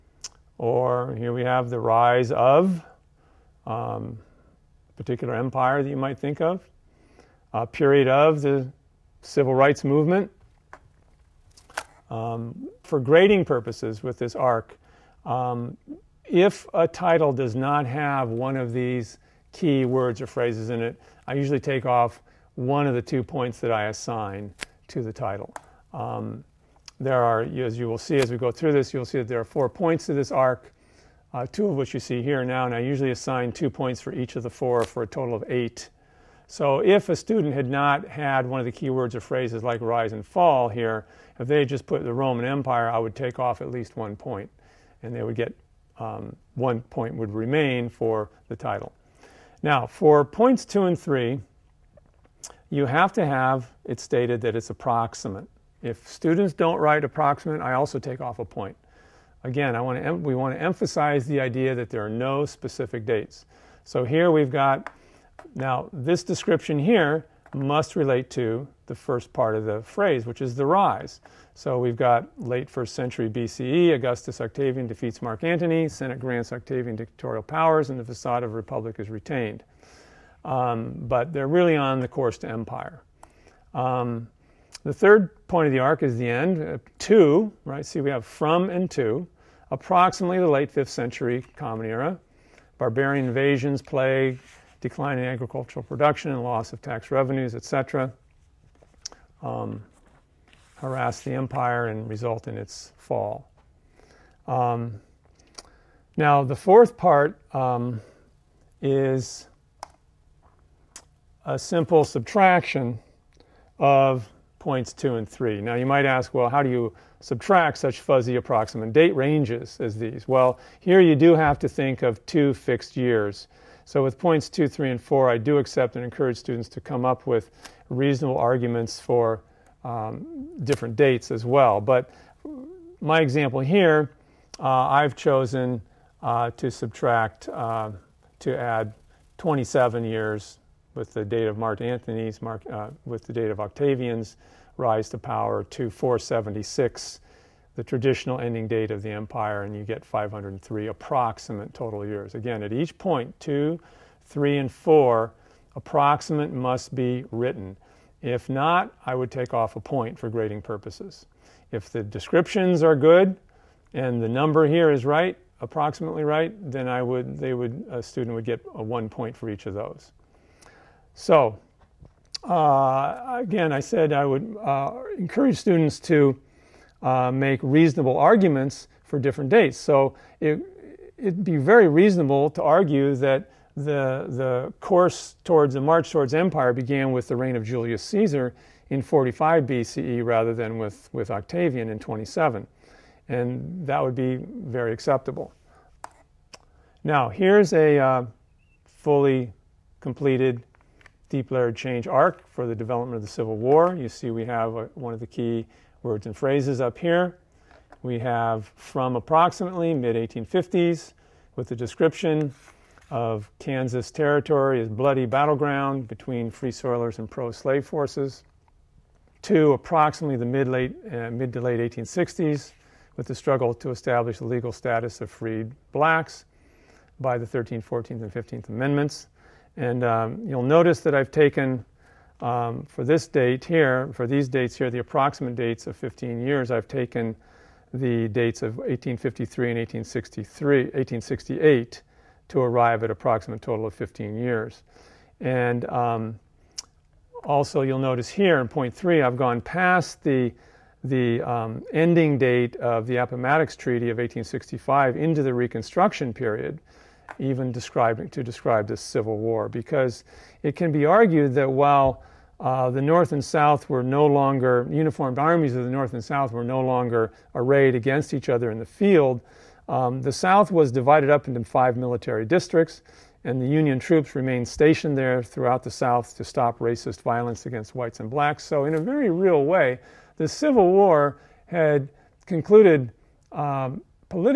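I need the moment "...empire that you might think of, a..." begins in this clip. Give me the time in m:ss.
0:05.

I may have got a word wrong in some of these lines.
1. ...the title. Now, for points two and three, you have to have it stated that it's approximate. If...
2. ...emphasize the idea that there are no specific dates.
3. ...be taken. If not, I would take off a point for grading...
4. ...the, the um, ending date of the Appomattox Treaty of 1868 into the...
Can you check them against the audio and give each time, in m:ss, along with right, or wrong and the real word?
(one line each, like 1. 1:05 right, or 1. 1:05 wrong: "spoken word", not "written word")
1. 0:48 right
2. 1:00 right
3. 2:36 wrong: "written", not "taken"
4. 4:10 wrong: "1865", not "1868".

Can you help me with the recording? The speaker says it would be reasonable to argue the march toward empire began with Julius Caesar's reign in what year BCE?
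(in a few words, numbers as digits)
45 BCE.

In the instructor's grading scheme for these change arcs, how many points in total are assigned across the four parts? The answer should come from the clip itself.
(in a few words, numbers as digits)
8.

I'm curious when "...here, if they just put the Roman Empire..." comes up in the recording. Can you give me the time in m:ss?
0:40.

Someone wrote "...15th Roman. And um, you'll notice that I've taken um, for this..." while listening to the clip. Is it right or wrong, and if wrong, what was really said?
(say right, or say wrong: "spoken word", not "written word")
wrong: "Amendments", not "Roman".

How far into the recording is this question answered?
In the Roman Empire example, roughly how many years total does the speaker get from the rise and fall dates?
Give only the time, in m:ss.
2:30.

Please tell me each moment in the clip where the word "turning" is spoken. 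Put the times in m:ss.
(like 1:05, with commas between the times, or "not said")
not said.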